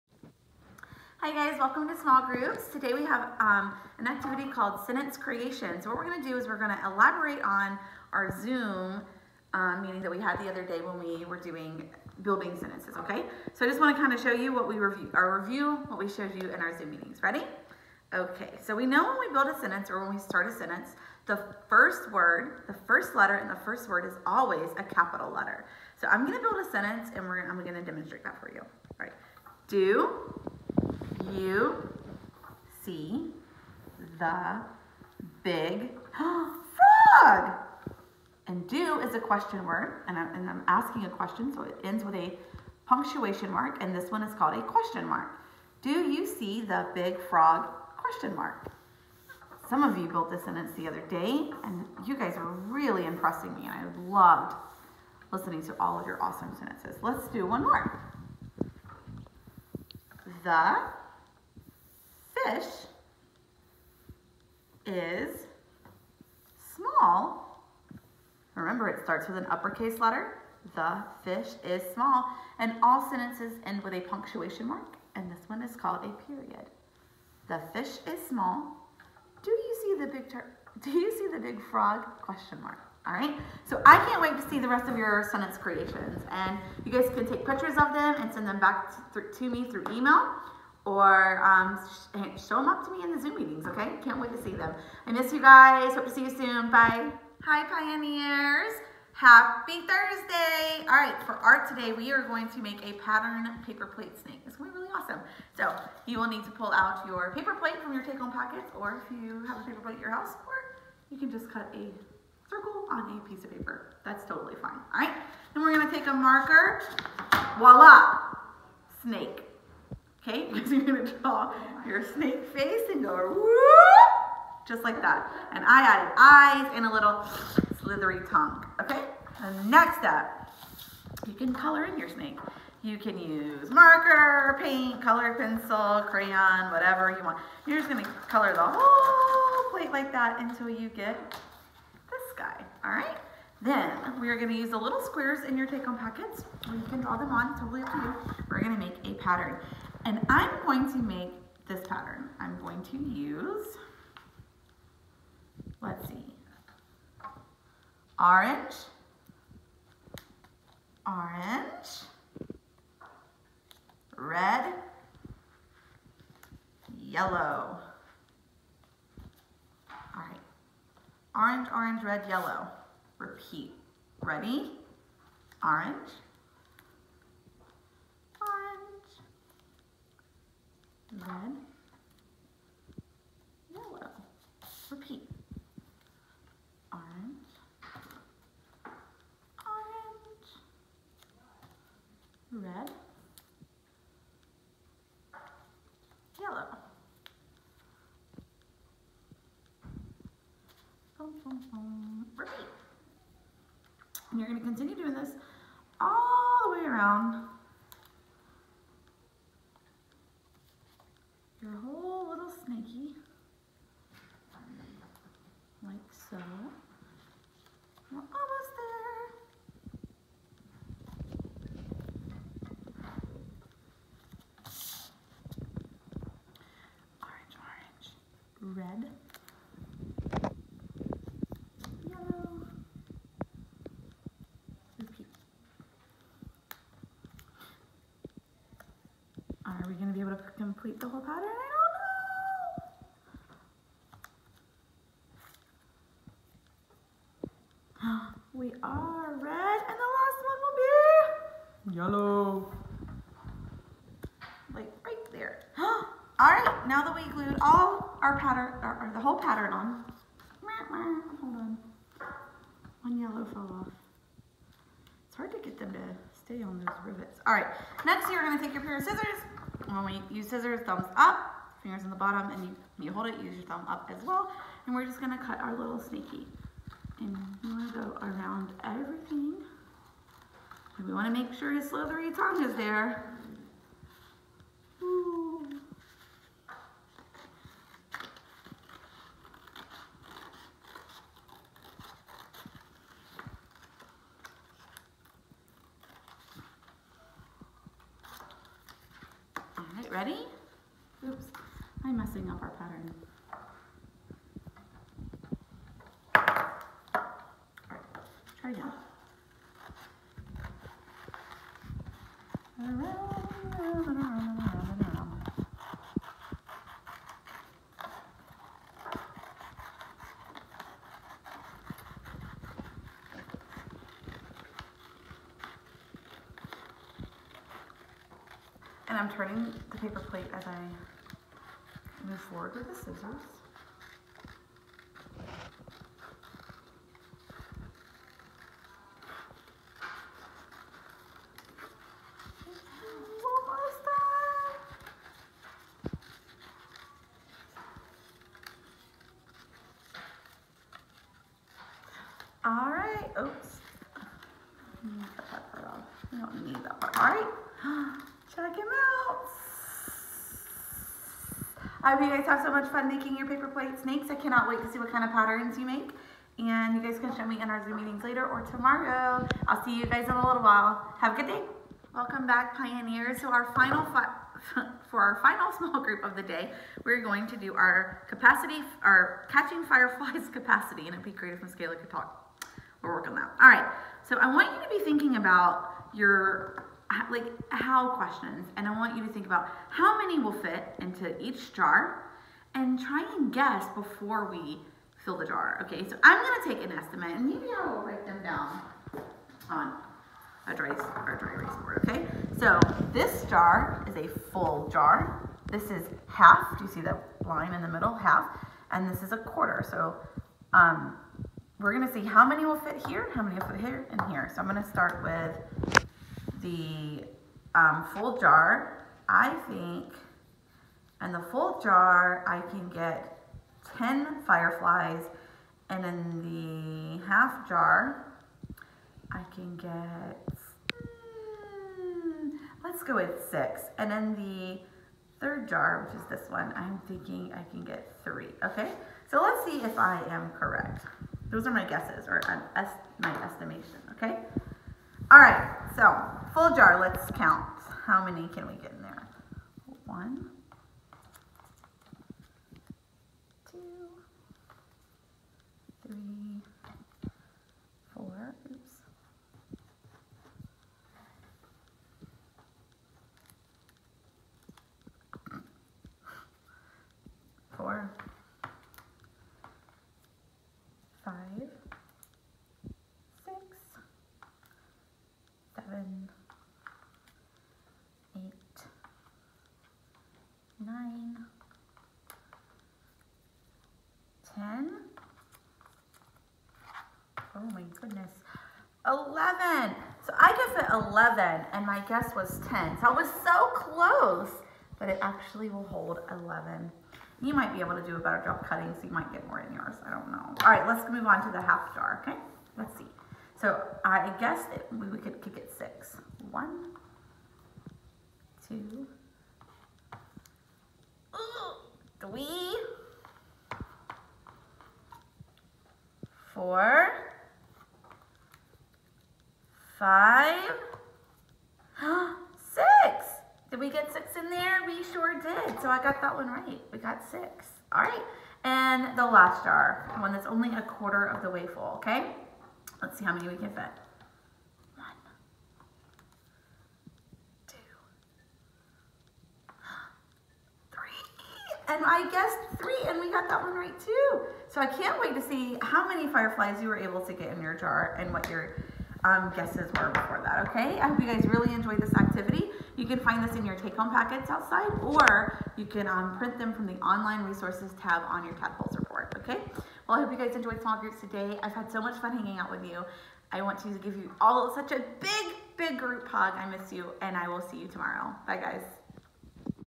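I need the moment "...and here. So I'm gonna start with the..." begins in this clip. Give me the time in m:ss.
6:54.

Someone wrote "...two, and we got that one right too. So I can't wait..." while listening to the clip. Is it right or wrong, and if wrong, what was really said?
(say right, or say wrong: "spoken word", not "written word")
wrong: "three", not "two".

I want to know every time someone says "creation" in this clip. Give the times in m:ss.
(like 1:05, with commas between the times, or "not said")
0:05, 1:25.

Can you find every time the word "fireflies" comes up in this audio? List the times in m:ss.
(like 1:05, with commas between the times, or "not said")
6:19, 7:04, 9:06.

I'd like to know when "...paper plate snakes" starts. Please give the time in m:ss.
6:03.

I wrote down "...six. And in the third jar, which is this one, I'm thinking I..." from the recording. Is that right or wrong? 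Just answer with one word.
right.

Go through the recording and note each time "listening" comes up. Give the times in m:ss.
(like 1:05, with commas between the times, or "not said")
0:55.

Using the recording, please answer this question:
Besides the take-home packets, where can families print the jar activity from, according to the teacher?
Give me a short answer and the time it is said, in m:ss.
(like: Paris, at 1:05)
Online resources tab, at 9:17.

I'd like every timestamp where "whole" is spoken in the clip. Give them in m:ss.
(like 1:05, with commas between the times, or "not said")
2:18, 4:01, 4:19.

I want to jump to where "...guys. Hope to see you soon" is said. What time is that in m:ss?
1:35.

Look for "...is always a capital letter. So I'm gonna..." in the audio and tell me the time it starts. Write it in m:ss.
0:24.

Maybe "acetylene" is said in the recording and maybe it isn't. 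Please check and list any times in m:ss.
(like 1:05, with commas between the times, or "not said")
not said.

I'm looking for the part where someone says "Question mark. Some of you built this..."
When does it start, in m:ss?
0:47.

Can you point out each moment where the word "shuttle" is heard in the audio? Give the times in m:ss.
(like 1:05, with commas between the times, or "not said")
not said.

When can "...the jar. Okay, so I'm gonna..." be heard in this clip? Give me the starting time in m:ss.
6:35.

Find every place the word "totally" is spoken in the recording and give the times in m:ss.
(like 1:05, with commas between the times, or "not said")
1:54, 2:27.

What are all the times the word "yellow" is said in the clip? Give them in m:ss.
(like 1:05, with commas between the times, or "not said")
2:46, 2:52, 3:03, 3:16, 3:52, 4:11, 4:23.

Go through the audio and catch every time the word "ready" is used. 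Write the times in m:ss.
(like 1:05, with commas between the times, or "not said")
0:17, 2:54, 5:00.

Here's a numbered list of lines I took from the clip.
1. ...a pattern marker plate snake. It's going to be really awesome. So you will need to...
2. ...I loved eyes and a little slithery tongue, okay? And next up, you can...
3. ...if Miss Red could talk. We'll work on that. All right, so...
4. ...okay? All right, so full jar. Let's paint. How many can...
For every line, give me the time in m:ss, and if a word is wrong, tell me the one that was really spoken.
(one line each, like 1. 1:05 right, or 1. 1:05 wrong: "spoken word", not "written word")
1. 1:42 wrong: "paper", not "marker"
2. 2:05 wrong: "added", not "loved"
3. 6:21 wrong: "Kayla", not "Red"
4. 7:24 wrong: "count", not "paint".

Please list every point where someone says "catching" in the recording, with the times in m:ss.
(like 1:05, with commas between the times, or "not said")
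6:19.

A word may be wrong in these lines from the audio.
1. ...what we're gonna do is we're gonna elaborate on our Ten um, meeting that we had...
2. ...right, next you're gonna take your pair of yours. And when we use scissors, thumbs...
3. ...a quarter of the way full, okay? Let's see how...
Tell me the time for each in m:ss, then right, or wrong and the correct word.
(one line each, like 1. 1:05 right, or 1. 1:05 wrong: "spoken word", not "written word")
1. 0:05 wrong: "Zoom", not "Ten"
2. 4:27 wrong: "scissors", not "yours"
3. 8:50 right.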